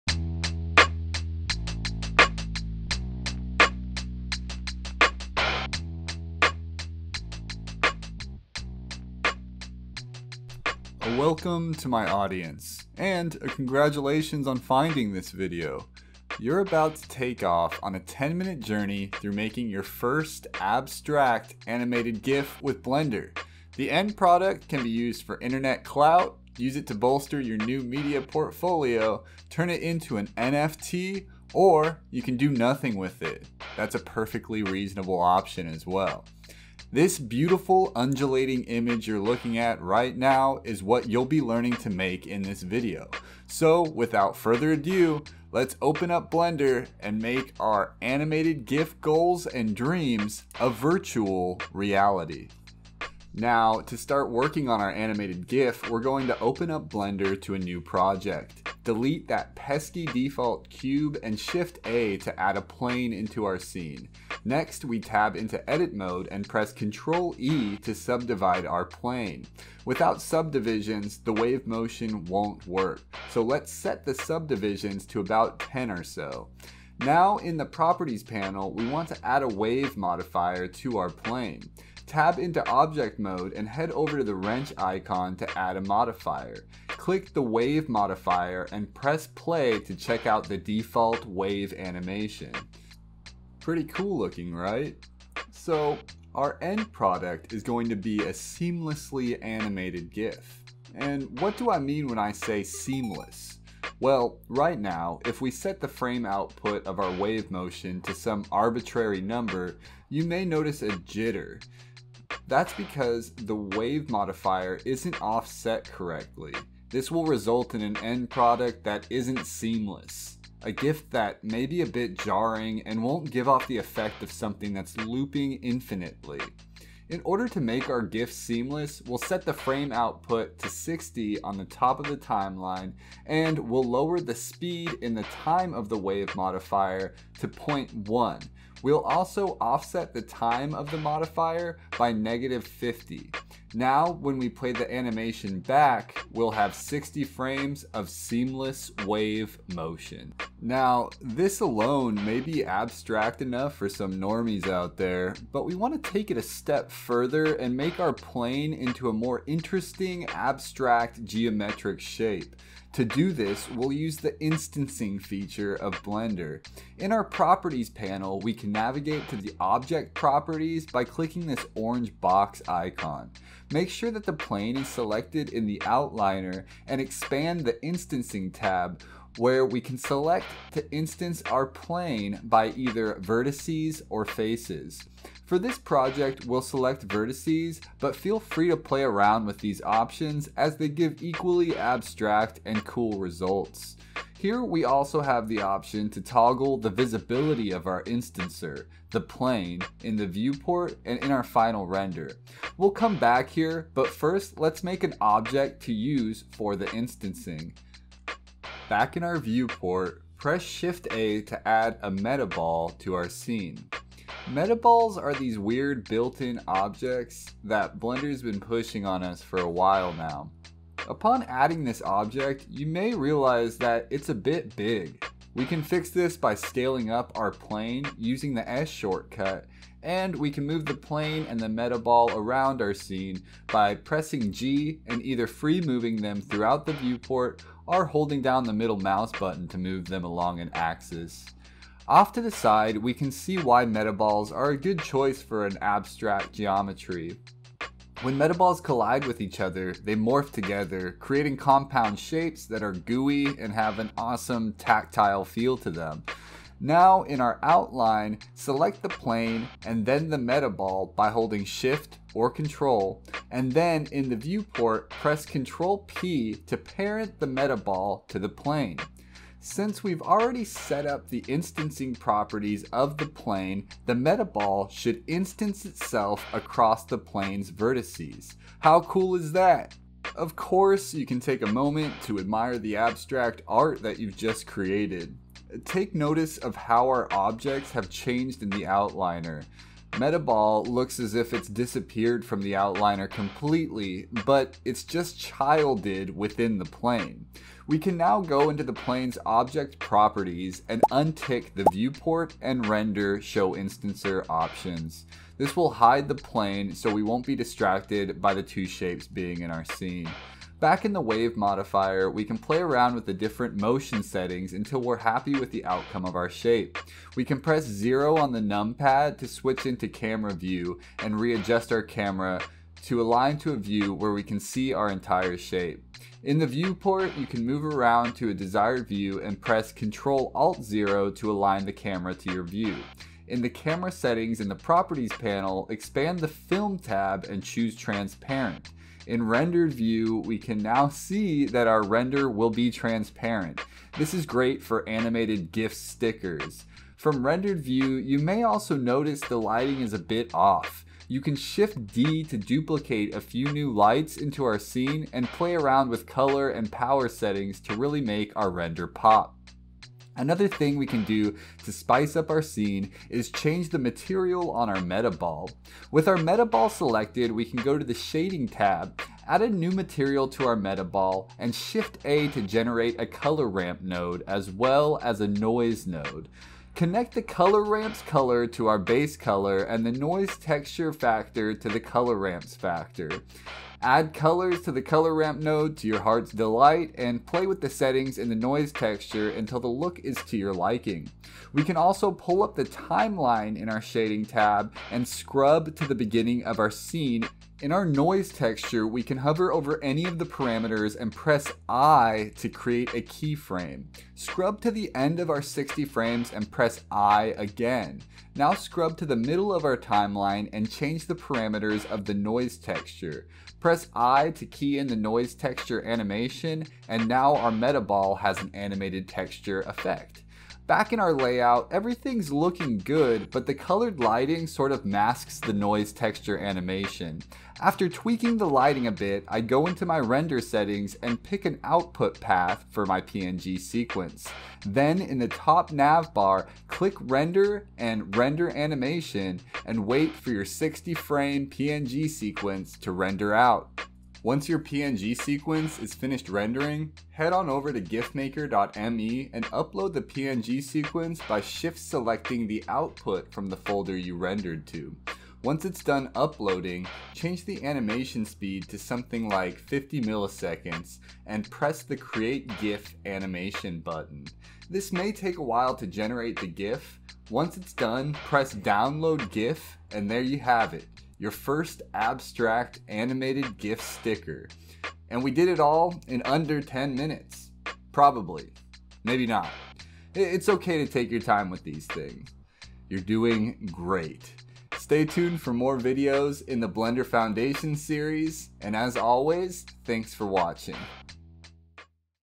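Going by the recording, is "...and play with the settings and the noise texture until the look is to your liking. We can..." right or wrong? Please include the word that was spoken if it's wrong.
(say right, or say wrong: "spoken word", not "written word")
right.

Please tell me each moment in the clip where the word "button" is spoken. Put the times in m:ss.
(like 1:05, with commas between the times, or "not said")
3:59, 7:43.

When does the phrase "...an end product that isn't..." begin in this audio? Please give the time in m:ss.
1:57.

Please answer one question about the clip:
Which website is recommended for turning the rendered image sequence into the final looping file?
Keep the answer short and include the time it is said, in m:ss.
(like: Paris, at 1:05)
gifmaker.me, at 7:28.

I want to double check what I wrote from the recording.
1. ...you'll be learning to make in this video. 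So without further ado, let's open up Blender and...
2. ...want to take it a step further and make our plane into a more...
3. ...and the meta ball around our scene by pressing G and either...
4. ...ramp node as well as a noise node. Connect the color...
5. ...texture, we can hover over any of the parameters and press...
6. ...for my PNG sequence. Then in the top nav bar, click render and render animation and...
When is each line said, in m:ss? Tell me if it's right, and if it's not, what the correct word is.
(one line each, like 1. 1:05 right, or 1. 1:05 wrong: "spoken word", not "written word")
1. 0:41 right
2. 2:35 right
3. 3:51 right
4. 6:13 right
5. 6:38 right
6. 7:12 right.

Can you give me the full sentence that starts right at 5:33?
In the camera settings in the properties panel, expand the film tab and choose transparent.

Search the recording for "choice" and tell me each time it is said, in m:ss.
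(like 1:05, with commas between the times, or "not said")
4:04.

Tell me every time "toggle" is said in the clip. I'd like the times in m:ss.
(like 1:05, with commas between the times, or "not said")
3:16.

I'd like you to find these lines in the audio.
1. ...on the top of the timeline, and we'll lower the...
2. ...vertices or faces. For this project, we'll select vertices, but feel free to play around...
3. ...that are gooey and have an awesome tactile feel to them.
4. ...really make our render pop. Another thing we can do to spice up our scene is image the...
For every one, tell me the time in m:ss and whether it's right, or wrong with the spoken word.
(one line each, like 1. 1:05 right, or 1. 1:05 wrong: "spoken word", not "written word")
1. 2:11 right
2. 3:03 right
3. 4:12 right
4. 5:57 wrong: "change", not "image".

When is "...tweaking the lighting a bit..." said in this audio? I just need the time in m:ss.
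7:08.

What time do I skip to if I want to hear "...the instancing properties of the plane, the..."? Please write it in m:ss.
4:31.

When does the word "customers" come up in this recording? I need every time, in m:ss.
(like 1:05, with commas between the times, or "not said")
not said.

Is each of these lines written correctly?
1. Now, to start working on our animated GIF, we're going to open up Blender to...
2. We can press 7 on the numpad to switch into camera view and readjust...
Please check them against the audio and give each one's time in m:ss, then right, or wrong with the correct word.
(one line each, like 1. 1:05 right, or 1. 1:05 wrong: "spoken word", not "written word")
1. 0:53 right
2. 5:17 wrong: "0", not "7".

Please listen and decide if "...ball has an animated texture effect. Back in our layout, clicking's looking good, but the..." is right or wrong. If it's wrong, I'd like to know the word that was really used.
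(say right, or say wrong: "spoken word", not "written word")
wrong: "everything", not "clicking".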